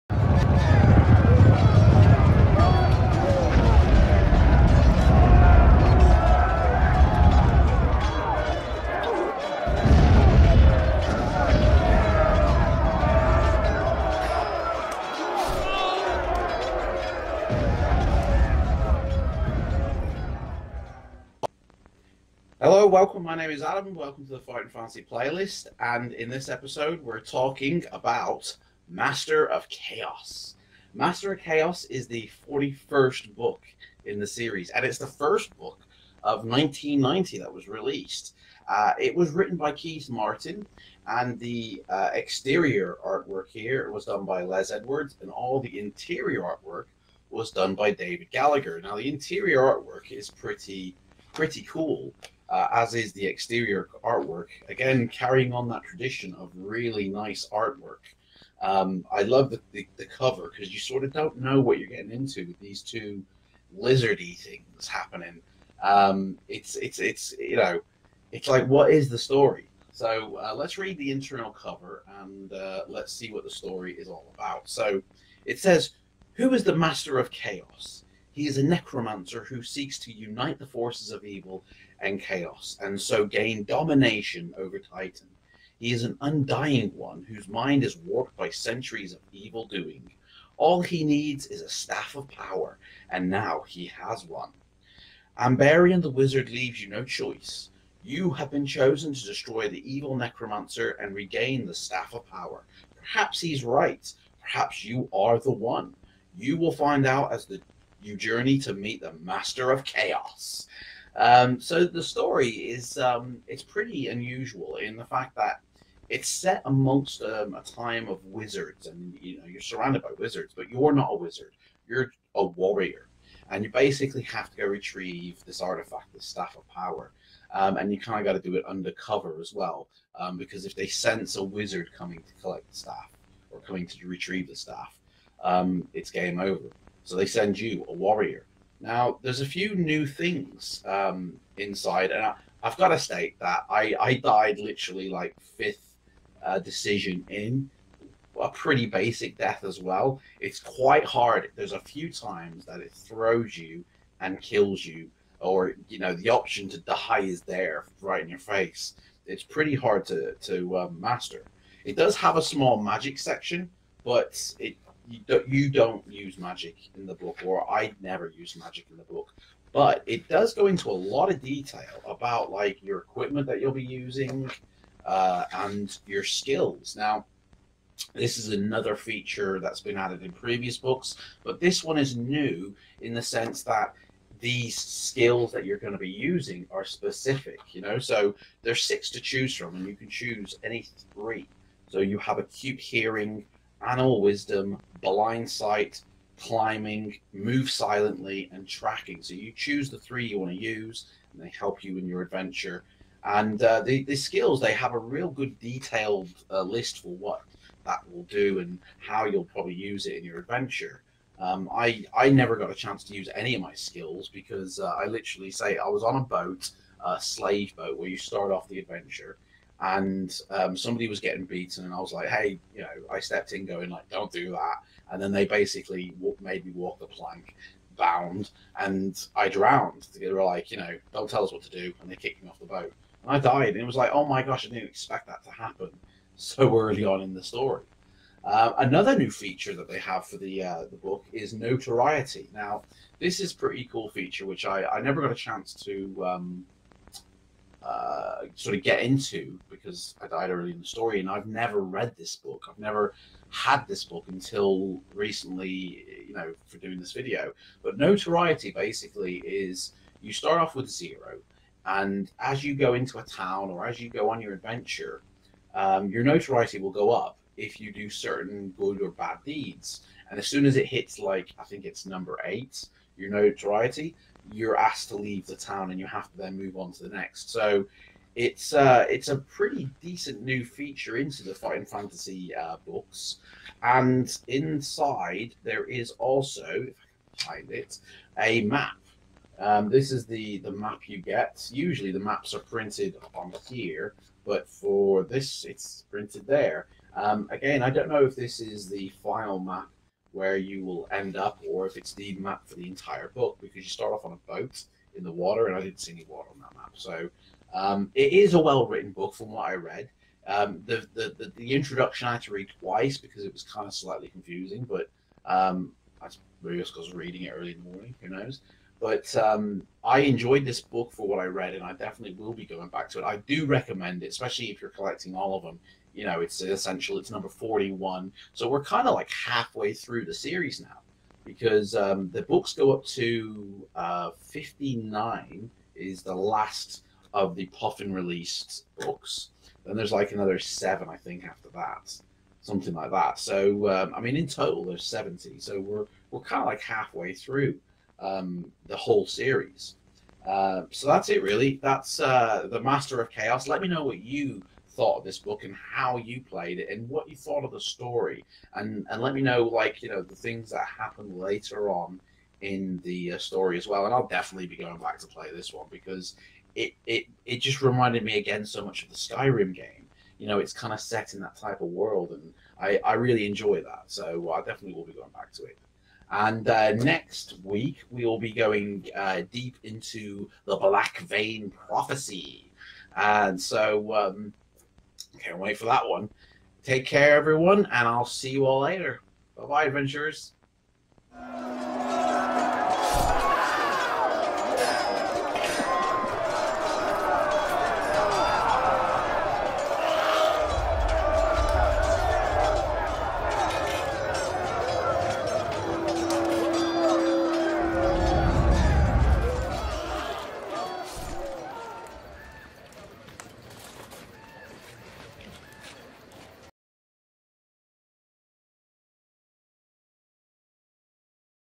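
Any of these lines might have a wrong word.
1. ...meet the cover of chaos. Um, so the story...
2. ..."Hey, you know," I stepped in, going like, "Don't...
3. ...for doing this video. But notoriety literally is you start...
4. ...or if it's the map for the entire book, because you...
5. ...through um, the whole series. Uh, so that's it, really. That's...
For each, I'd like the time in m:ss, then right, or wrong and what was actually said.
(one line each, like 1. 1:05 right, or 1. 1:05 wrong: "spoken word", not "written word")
1. 1:48 wrong: "master", not "cover"
2. 3:42 right
3. 4:16 wrong: "basically", not "literally"
4. 5:01 right
5. 5:47 right.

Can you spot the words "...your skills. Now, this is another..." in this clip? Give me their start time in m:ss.
2:56.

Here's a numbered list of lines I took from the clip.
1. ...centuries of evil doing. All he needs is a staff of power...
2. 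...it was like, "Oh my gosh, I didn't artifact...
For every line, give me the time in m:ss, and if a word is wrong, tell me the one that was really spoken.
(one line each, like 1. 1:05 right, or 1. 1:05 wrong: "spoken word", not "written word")
1. 1:28 right
2. 3:53 wrong: "expect", not "artifact".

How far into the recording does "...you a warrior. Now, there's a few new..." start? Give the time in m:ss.
2:17.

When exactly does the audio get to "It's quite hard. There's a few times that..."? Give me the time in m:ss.
2:30.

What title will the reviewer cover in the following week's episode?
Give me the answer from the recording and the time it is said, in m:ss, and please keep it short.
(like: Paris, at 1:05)
Black Vein Prophecy, at 6:20.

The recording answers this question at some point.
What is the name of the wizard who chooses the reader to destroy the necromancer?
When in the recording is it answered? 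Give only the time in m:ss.
1:35.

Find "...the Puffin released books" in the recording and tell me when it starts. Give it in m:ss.
5:37.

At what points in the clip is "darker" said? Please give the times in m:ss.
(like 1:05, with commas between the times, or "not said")
not said.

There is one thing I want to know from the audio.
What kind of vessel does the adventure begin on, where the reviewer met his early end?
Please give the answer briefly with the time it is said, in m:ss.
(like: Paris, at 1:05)
A slave boat, at 3:37.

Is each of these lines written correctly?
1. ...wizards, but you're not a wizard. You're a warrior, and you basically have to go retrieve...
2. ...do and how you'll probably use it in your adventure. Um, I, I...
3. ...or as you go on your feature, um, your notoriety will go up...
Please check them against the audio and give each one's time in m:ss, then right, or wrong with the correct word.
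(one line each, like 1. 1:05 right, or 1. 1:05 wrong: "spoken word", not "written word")
1. 2:00 right
2. 3:28 right
3. 4:23 wrong: "adventure", not "feature".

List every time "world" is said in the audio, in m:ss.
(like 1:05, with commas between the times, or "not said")
6:11.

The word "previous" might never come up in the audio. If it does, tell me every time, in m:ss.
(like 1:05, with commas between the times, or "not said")
3:00.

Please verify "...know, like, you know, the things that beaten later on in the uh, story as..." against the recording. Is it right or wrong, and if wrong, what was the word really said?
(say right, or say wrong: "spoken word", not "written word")
wrong: "happen", not "beaten".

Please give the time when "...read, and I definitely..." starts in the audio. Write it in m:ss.
5:21.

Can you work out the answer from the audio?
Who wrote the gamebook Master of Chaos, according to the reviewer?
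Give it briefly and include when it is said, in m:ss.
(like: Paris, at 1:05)
Keith Martin, at 0:39.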